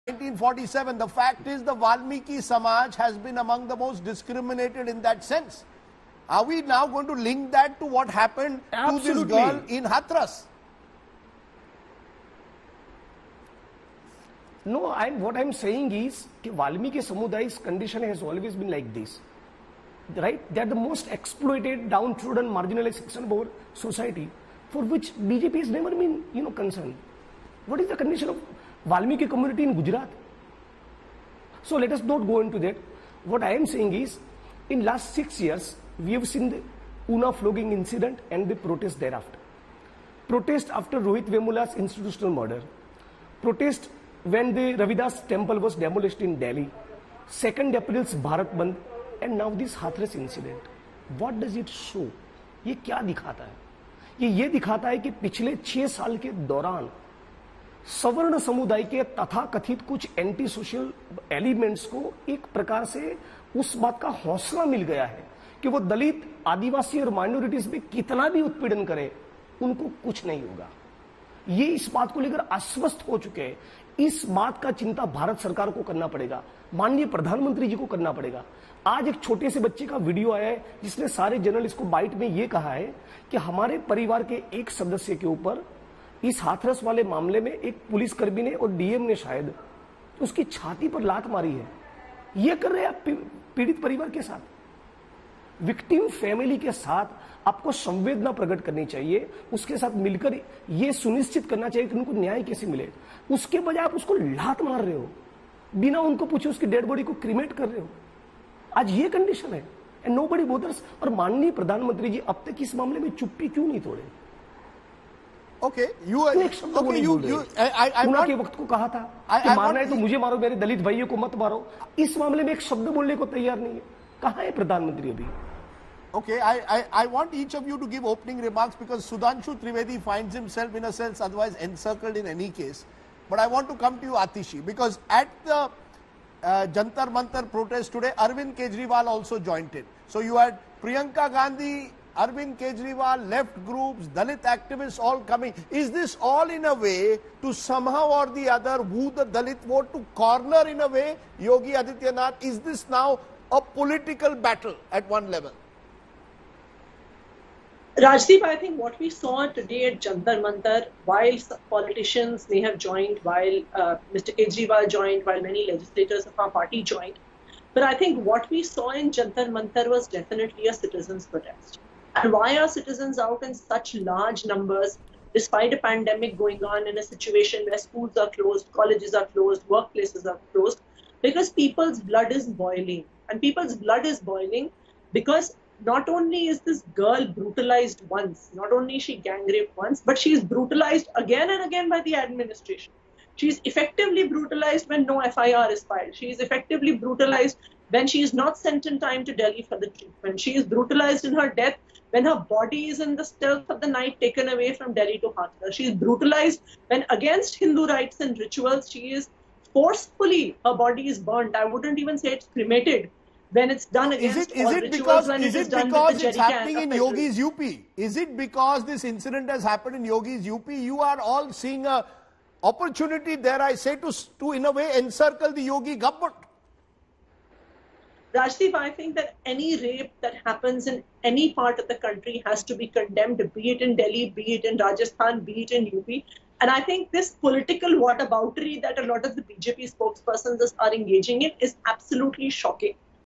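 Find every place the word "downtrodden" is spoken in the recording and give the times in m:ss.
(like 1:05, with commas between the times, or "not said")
0:21.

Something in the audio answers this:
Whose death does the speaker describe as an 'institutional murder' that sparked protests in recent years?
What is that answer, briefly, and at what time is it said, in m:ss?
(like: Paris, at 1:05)
Rohit Vemula, at 0:40.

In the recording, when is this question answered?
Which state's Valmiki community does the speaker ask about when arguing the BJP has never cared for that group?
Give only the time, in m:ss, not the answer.
0:29.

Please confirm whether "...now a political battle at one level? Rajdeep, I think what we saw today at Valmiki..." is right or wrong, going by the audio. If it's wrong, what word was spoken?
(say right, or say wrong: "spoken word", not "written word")
wrong: "Jantar", not "Valmiki".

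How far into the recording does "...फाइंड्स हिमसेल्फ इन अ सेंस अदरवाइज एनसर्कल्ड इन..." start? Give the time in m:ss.
2:10.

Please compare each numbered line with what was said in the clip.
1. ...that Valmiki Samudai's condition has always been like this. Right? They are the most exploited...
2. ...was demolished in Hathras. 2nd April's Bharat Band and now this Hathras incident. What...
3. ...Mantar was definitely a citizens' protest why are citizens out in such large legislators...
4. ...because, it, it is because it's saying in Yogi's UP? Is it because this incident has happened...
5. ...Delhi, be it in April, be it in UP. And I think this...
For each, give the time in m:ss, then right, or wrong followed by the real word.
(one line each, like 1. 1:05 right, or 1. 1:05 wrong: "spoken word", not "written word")
1. 0:16 right
2. 0:45 wrong: "Delhi", not "Hathras"
3. 2:49 wrong: "numbers", not "legislators"
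4. 3:34 wrong: "happening", not "saying"
5. 3:53 wrong: "Rajasthan", not "April".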